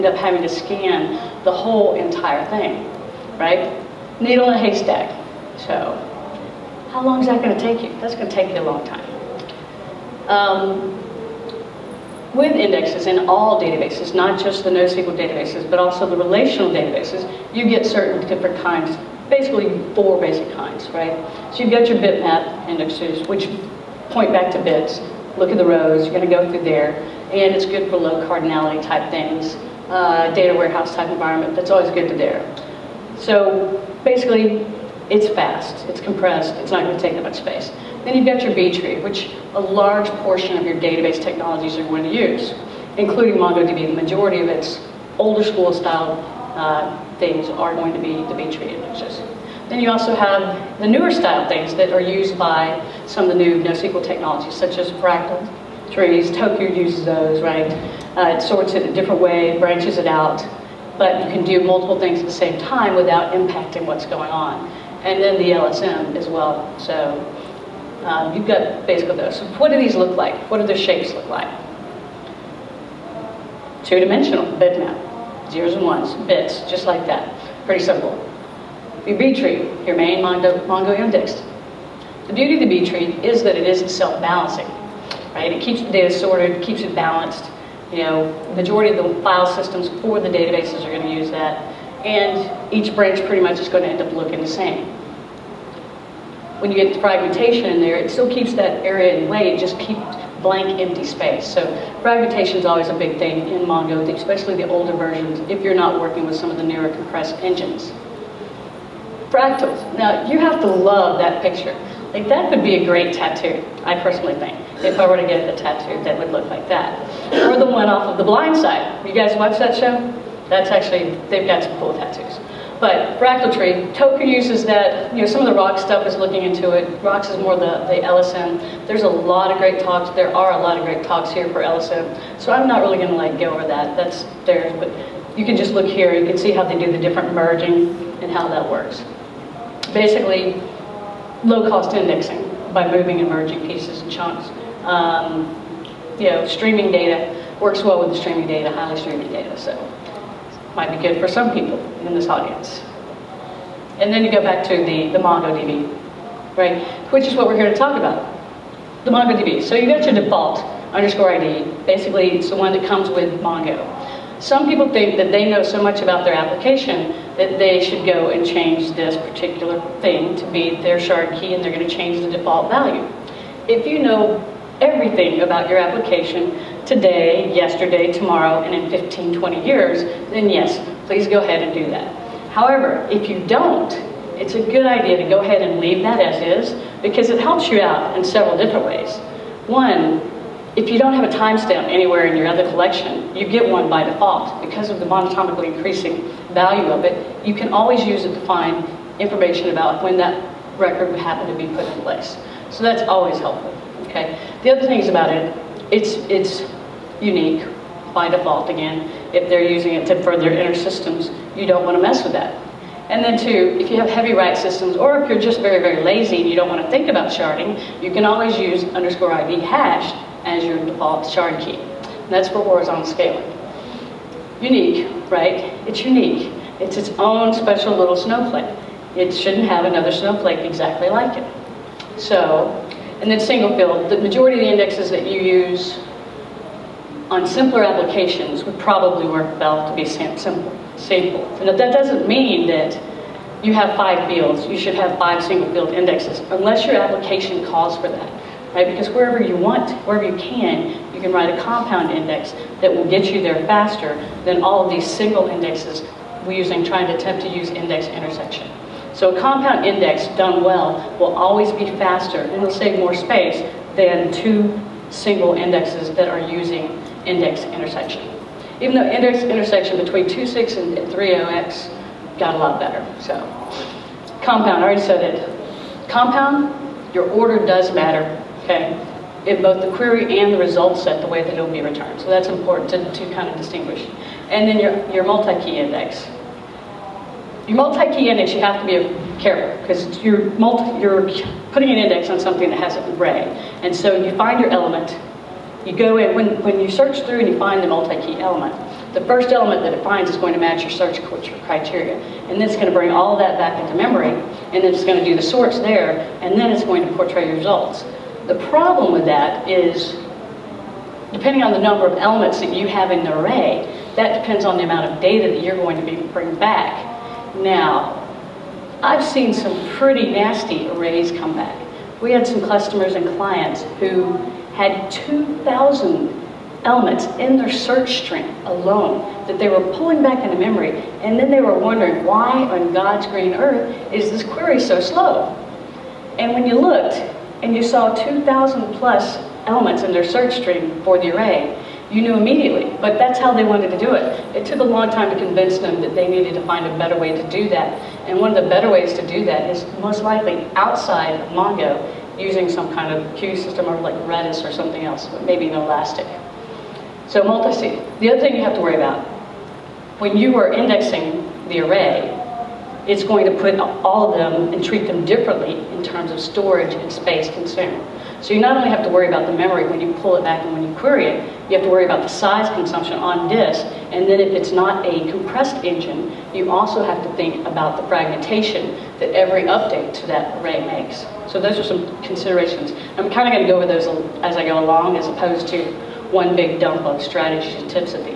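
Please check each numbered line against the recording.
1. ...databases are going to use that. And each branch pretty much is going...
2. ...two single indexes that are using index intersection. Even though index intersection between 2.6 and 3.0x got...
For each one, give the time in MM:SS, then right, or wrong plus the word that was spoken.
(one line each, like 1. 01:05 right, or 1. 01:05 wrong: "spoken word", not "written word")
1. 01:30 right
2. 04:24 right.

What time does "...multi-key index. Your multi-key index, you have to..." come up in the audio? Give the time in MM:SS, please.
04:45.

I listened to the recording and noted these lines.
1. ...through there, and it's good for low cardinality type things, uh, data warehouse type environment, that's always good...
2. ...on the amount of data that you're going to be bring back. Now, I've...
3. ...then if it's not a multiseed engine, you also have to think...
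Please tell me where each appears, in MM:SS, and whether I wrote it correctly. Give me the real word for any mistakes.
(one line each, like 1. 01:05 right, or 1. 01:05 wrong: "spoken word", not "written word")
1. 00:26 right
2. 05:14 right
3. 06:14 wrong: "compressed", not "multiseed".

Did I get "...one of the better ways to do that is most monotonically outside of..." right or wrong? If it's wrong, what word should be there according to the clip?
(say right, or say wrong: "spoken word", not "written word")
wrong: "likely", not "monotonically".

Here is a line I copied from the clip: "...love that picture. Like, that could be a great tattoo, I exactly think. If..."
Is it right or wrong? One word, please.
wrong.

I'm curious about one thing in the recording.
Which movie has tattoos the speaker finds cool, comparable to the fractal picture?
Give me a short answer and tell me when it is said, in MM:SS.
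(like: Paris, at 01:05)
The Blind Side, at 01:58.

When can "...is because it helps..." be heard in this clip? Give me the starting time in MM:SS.
03:06.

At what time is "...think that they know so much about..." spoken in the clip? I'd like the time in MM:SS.
02:44.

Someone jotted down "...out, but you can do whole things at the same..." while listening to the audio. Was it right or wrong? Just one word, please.
wrong.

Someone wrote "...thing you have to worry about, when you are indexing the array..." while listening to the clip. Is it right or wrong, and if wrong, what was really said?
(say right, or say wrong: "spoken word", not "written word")
right.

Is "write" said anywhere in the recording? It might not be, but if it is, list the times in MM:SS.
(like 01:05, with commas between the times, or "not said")
03:34, 04:11.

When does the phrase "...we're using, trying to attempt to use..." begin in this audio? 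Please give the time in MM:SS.
04:16.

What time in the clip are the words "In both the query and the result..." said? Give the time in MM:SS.
04:39.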